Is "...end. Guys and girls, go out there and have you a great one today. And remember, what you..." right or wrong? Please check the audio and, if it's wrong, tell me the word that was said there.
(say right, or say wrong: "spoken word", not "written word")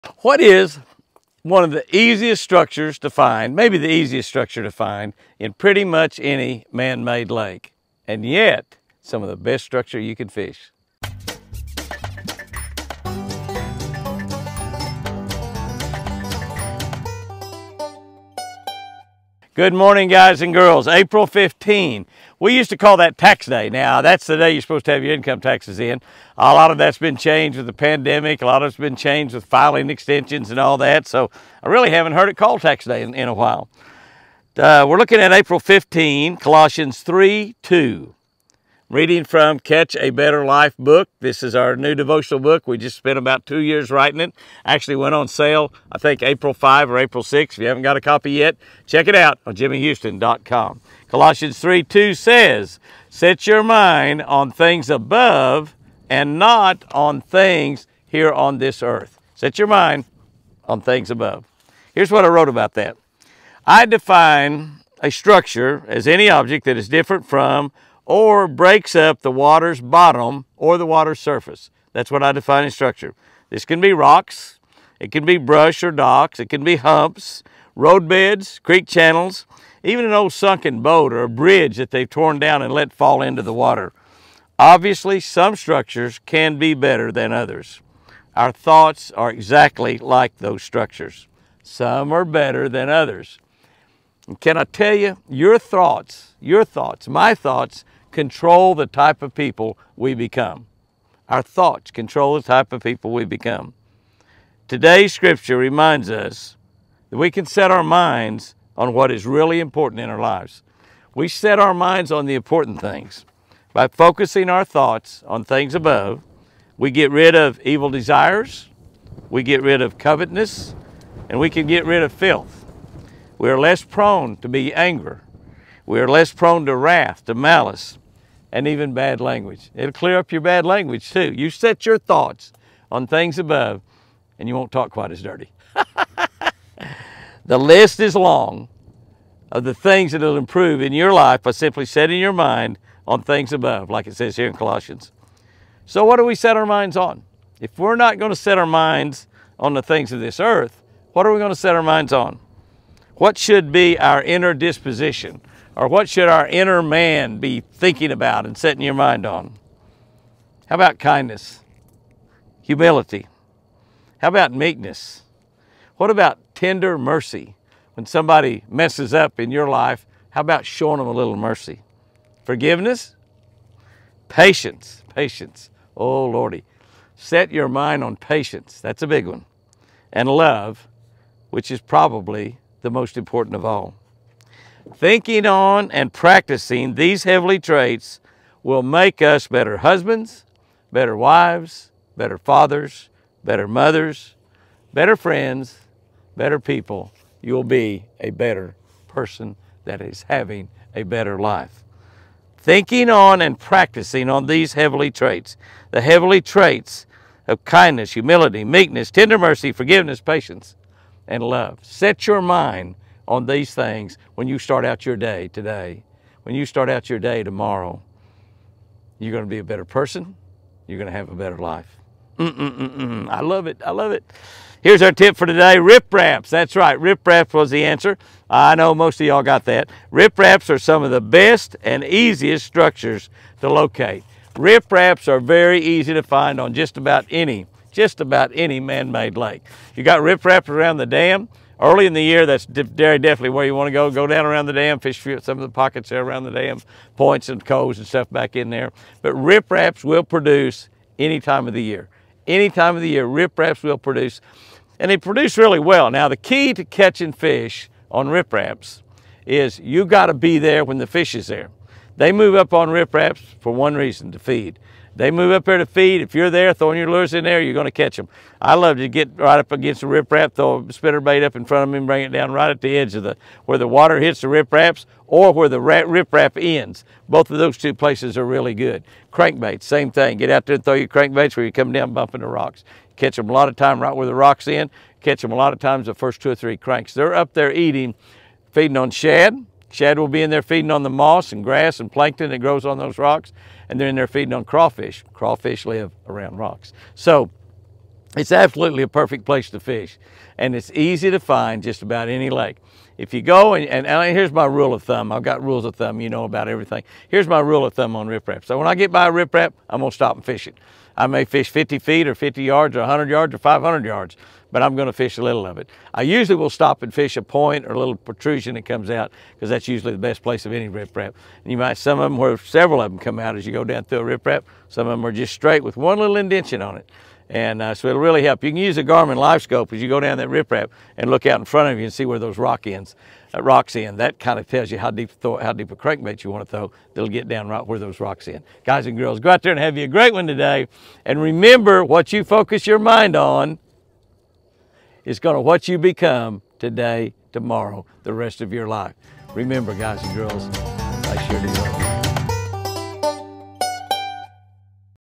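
right.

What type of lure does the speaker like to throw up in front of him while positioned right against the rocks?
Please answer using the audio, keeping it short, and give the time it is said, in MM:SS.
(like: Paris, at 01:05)
Spinner bait, at 04:30.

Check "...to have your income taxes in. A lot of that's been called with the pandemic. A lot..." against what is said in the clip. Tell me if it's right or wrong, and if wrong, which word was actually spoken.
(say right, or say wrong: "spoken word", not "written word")
wrong: "changed", not "called".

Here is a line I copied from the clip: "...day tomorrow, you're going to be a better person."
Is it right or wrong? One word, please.
right.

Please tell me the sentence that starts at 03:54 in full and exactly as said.
Ripraps are very easy to find on just about any just about any man-made lake.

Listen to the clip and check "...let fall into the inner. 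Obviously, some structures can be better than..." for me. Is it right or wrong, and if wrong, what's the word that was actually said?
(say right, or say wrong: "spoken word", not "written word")
wrong: "water", not "inner".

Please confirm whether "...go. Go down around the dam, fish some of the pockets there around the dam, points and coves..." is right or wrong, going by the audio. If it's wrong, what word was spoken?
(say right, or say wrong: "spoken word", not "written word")
right.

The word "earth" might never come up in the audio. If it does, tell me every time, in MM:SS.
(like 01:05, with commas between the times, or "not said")
00:58, 02:30.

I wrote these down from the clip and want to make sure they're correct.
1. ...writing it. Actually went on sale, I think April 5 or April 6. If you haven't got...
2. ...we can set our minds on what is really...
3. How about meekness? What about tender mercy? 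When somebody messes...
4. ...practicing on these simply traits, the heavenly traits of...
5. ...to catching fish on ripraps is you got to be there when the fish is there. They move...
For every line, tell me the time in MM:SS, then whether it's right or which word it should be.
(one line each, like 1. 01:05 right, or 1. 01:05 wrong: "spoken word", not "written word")
1. 00:43 right
2. 01:47 right
3. 02:44 right
4. 03:23 wrong: "heavenly", not "simply"
5. 04:16 right.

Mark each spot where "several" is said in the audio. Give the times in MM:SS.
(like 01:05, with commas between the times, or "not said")
05:22.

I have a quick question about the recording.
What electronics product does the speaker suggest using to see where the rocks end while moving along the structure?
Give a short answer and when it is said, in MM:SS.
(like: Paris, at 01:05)
Garmin Livescope, at 05:29.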